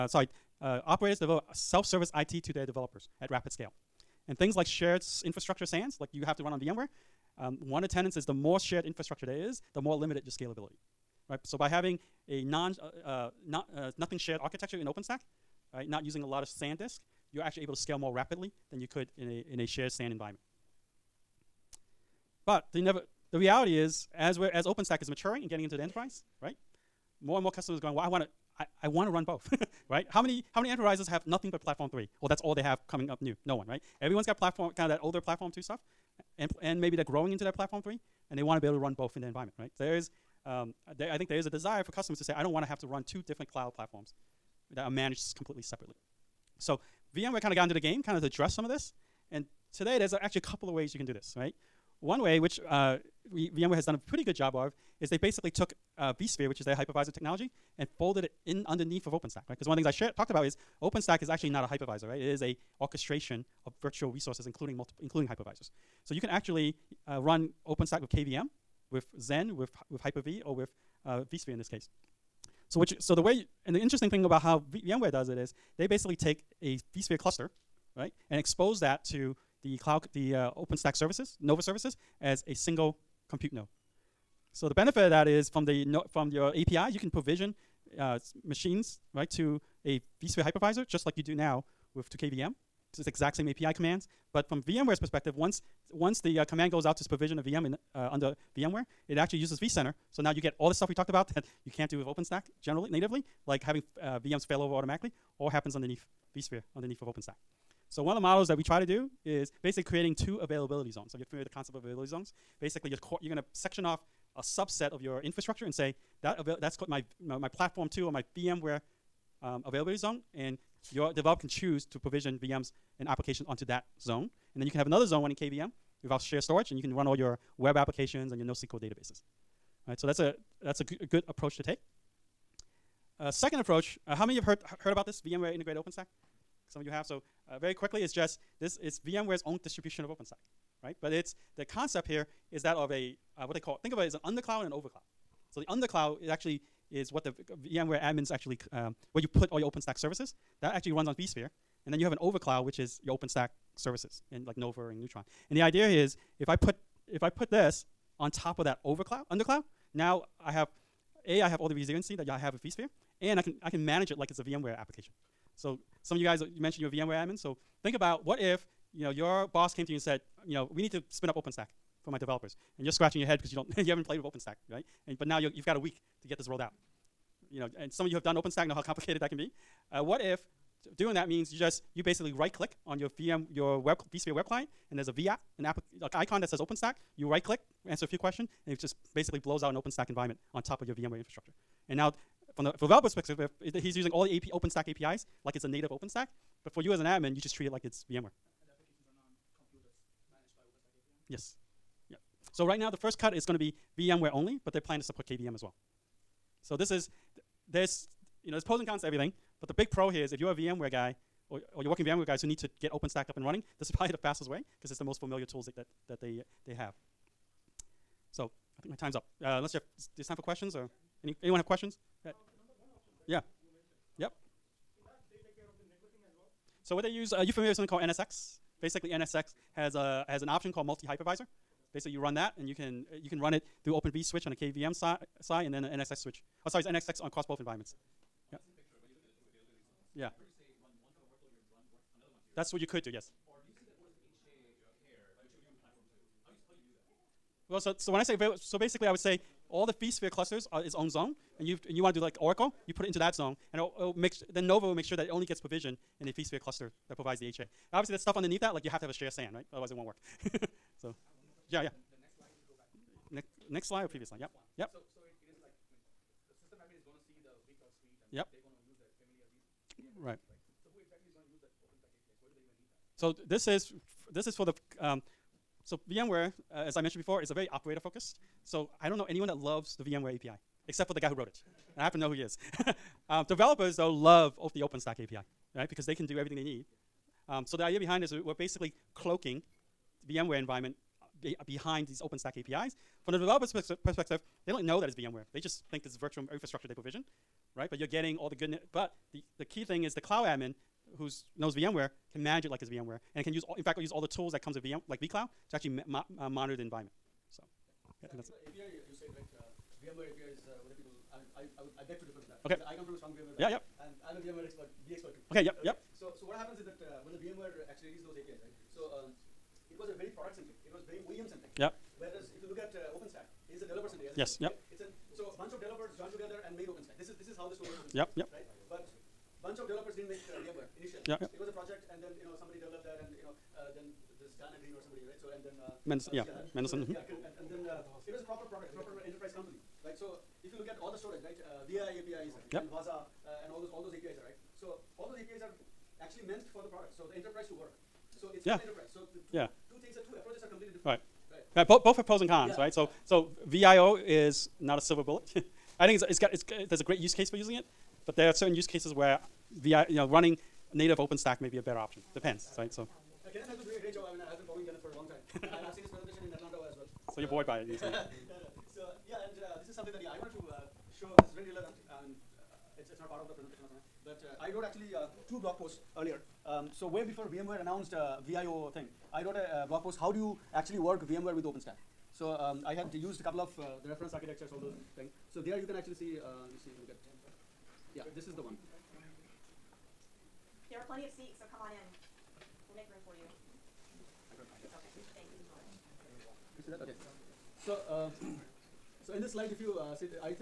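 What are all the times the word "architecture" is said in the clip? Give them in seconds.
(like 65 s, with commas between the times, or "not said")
14 s, 384 s.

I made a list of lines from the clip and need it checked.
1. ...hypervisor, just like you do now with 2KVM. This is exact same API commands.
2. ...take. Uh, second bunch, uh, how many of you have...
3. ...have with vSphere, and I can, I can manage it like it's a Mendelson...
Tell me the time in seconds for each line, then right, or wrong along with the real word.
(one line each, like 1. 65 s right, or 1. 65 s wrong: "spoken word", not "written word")
1. 90 s right
2. 131 s wrong: "approach", not "bunch"
3. 162 s wrong: "VMware", not "Mendelson".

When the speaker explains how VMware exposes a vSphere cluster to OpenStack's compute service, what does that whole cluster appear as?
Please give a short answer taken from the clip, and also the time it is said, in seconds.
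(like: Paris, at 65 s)
a single compute node, at 82 s.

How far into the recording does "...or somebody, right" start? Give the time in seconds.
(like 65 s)
334 s.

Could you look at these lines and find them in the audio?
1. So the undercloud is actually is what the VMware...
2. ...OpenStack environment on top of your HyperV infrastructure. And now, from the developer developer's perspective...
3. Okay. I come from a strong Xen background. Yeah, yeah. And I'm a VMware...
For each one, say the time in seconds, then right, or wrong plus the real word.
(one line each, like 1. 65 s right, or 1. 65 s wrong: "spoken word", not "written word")
1. 145 s right
2. 189 s wrong: "VMware", not "HyperV"
3. 312 s wrong: "VMware", not "Xen".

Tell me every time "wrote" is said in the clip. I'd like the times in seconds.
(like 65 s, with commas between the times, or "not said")
281 s, 374 s, 379 s.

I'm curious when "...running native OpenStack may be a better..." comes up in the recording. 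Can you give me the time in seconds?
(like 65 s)
360 s.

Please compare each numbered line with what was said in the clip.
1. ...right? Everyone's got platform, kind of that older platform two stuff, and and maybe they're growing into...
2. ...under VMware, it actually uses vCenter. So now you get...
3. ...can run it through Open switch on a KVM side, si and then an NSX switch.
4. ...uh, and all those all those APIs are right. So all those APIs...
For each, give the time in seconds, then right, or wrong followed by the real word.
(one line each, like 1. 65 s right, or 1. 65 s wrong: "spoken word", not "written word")
1. 33 s right
2. 98 s right
3. 233 s right
4. 343 s right.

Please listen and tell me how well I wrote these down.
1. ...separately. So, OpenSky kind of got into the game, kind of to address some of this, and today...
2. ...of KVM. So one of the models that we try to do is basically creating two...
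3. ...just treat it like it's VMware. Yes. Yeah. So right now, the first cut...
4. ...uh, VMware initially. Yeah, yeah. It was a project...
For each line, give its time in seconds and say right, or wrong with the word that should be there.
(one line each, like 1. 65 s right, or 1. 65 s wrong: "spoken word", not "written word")
1. 45 s wrong: "VMware", not "OpenSky"
2. 107 s wrong: "OpenStack", not "KVM"
3. 197 s right
4. 330 s right.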